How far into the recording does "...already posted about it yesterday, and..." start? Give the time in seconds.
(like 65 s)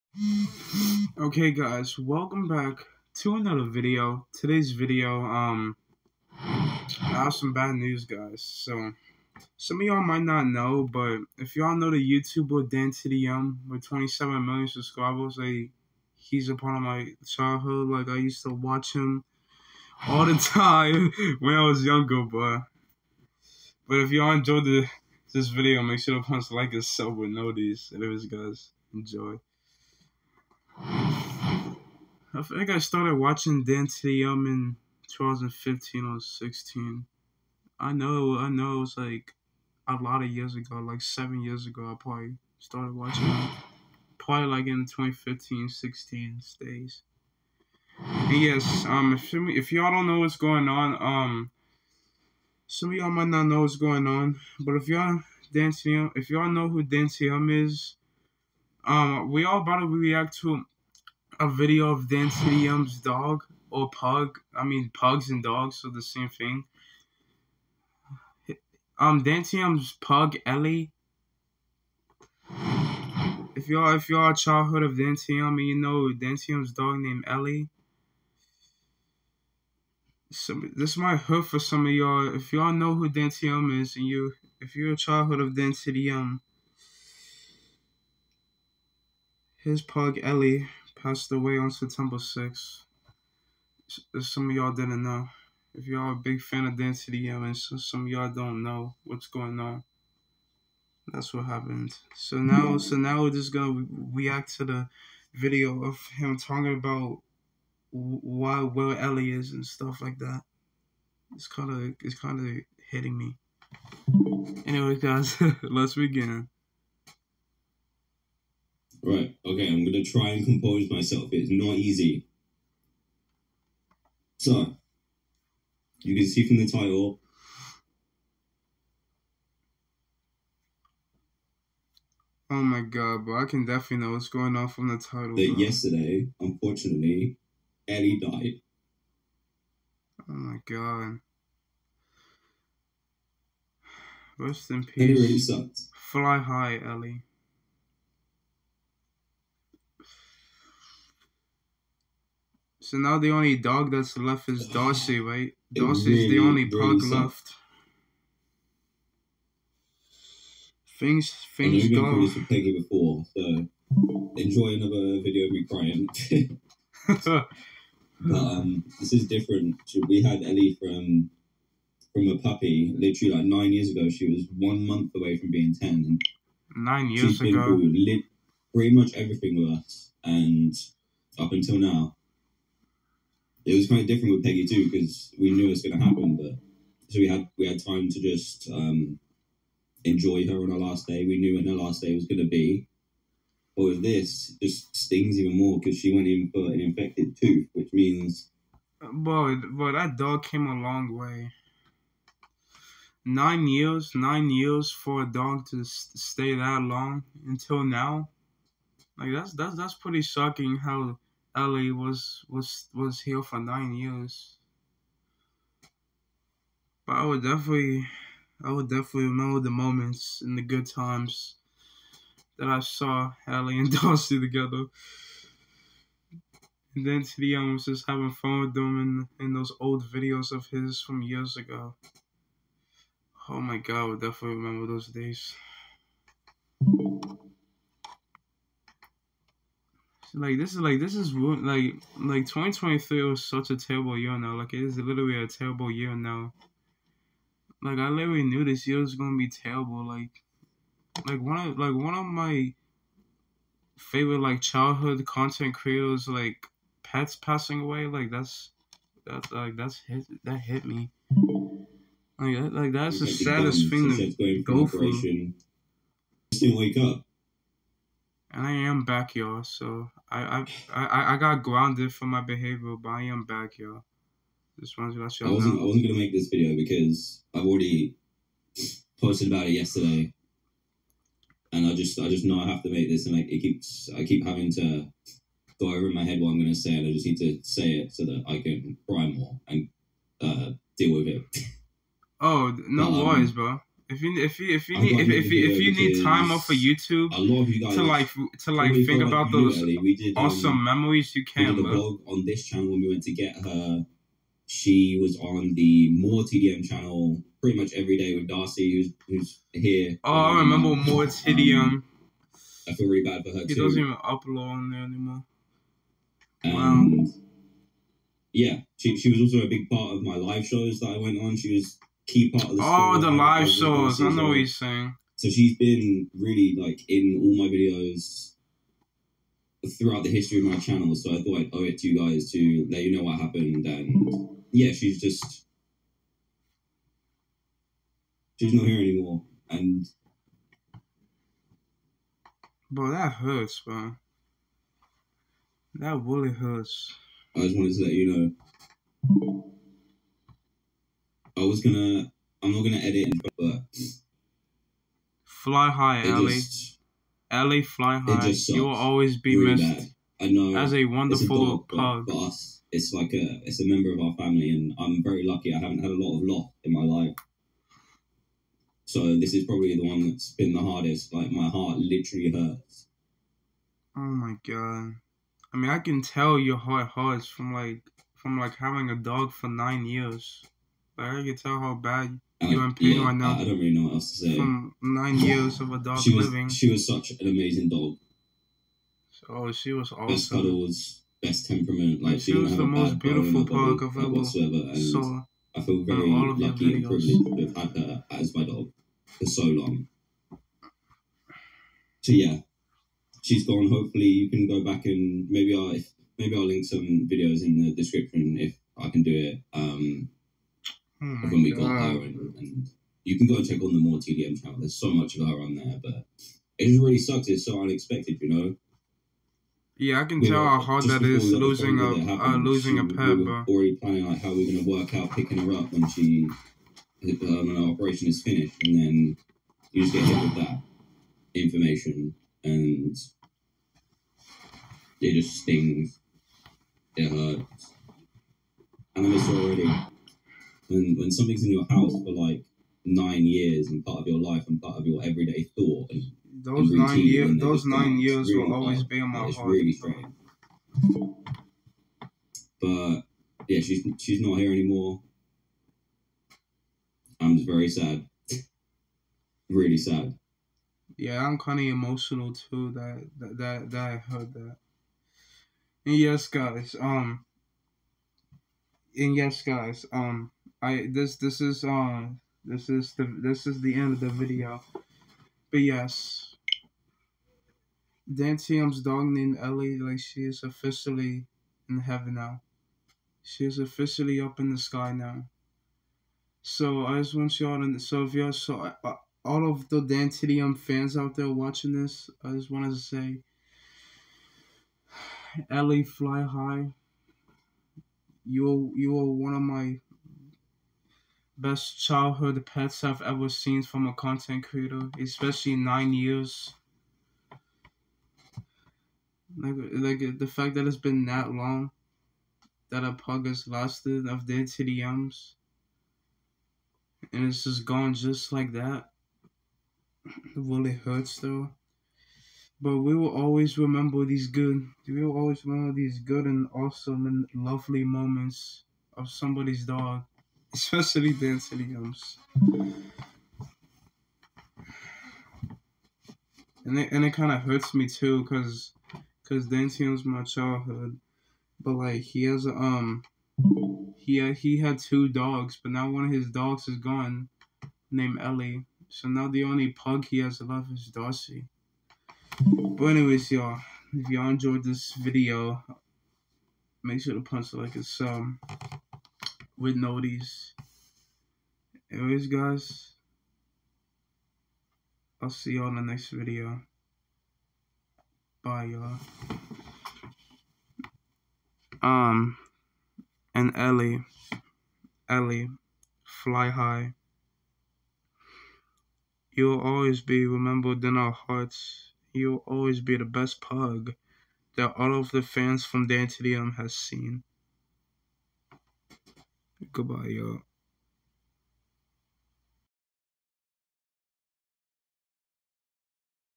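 277 s.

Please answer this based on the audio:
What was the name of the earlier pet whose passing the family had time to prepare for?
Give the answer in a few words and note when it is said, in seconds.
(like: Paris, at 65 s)
Peggy, at 184 s.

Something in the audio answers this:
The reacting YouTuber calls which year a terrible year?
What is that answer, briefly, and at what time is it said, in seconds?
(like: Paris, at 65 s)
2023, at 242 s.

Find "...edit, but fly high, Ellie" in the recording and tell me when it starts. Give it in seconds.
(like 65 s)
352 s.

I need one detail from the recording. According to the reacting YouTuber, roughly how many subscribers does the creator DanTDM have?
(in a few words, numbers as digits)
27 million.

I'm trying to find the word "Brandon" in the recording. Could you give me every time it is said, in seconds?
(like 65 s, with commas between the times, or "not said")
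not said.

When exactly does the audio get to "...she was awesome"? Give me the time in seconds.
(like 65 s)
389 s.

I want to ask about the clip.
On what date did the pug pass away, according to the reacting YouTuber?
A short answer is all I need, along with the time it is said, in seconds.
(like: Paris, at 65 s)
September 6th, at 91 s.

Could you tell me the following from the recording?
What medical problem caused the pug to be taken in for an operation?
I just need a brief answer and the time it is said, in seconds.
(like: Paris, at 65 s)
an infected tooth, at 196 s.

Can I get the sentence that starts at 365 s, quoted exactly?
I haven't had a lot of loss in my life.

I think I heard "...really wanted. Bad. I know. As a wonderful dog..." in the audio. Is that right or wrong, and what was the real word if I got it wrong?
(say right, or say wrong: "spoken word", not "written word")
wrong: "missed", not "wanted".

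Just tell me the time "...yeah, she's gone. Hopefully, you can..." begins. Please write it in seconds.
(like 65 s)
402 s.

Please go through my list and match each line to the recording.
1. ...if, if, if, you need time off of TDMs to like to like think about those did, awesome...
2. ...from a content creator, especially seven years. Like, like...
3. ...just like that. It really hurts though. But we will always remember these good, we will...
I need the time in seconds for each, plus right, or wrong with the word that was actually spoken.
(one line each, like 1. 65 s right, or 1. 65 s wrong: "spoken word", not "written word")
1. 295 s wrong: "YouTube", not "TDMs"
2. 503 s wrong: "nine", not "seven"
3. 518 s right.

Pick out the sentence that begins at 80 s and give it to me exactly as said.
Some, this might hurt for some of y'all.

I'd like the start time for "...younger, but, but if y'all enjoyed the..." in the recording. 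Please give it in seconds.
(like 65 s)
21 s.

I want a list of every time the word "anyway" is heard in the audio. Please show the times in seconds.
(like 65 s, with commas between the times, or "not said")
114 s, 553 s, 562 s.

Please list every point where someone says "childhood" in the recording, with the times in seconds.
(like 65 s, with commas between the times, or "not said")
17 s, 74 s, 84 s, 254 s, 502 s, 540 s.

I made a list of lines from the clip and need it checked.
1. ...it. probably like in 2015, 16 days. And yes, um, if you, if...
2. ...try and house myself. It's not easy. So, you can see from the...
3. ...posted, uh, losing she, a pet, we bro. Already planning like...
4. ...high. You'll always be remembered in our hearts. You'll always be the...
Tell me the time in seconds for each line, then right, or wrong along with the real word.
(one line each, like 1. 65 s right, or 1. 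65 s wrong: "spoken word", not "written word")
1. 43 s right
2. 120 s wrong: "compose", not "house"
3. 422 s wrong: "happened", not "posted"
4. 576 s right.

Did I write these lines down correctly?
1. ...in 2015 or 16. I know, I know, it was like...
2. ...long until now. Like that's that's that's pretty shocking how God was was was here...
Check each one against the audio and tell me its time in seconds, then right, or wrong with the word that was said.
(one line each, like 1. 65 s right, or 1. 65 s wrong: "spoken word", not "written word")
1. 34 s right
2. 206 s wrong: "Ellie", not "God".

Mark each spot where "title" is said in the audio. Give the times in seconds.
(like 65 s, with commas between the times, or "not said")
126 s, 134 s.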